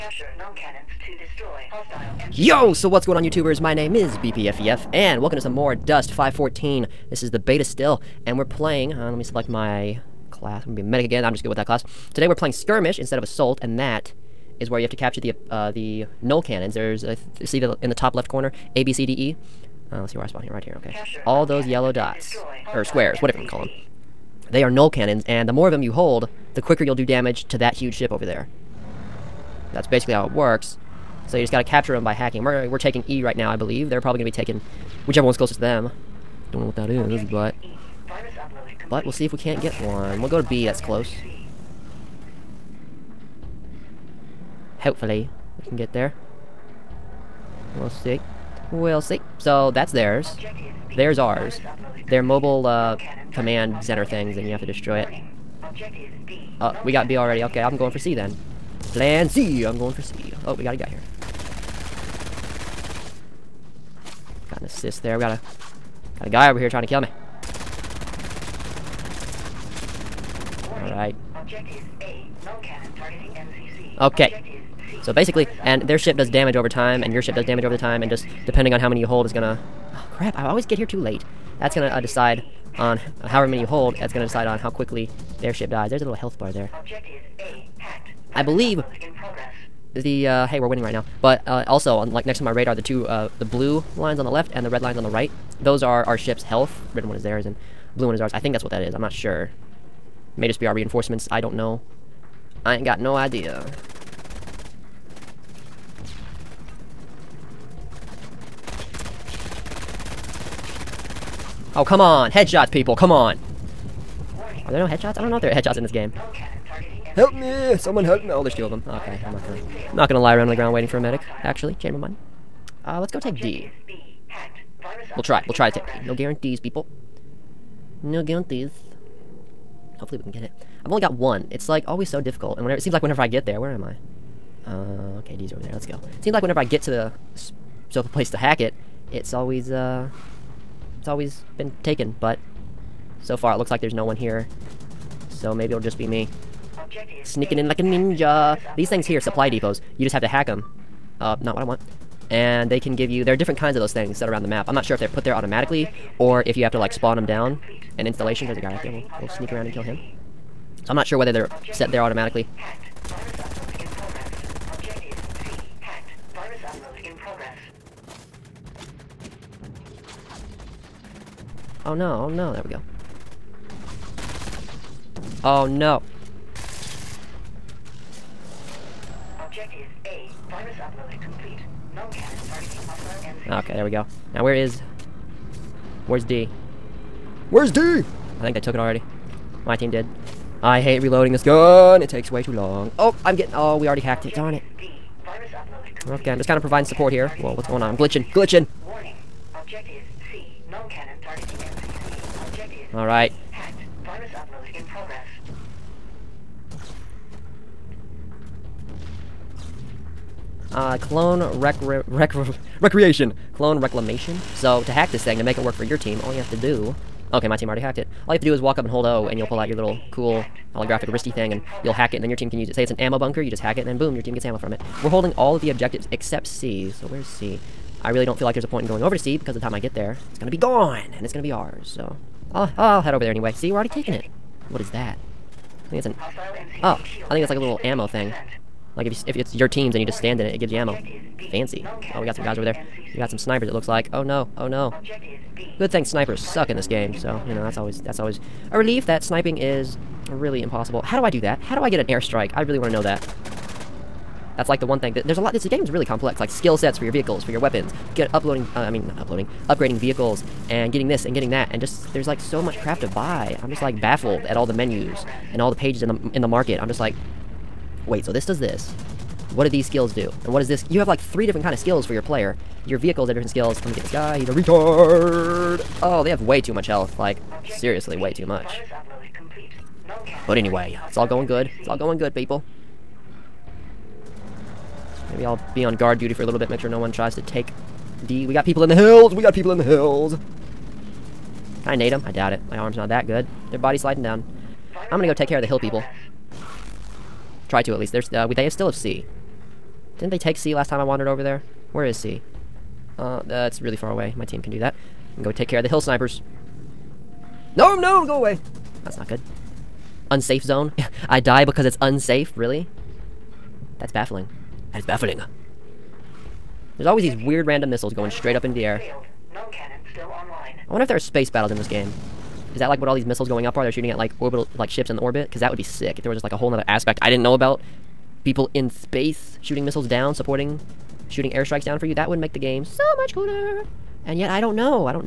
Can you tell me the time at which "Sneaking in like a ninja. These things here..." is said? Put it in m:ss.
2:27.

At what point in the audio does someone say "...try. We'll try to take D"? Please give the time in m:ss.
2:05.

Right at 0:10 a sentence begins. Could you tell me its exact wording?
I'm gonna be a medic again, I'm just good with that class.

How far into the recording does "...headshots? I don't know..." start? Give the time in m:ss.
1:54.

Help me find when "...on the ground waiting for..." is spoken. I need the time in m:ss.
2:00.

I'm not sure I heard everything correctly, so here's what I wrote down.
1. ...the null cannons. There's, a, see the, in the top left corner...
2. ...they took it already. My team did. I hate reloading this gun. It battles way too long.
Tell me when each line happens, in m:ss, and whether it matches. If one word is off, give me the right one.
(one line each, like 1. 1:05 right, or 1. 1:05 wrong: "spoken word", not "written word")
1. 0:15 right
2. 3:08 wrong: "takes", not "battles".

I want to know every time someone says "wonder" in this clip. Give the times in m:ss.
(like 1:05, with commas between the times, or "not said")
5:20.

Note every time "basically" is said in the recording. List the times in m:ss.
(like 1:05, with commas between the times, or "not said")
0:29, 1:15.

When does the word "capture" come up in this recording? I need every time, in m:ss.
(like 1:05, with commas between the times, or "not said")
0:14, 0:31.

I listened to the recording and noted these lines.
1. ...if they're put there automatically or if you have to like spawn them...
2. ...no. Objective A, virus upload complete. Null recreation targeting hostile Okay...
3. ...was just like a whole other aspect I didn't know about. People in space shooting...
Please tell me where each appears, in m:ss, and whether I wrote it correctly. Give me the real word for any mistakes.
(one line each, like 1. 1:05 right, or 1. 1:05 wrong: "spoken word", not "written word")
1. 2:34 right
2. 2:55 wrong: "cannon", not "recreation"
3. 5:26 right.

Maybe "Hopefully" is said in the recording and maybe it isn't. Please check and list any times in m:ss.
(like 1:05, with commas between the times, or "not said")
0:44, 2:09.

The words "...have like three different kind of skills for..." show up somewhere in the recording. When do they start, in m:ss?
4:30.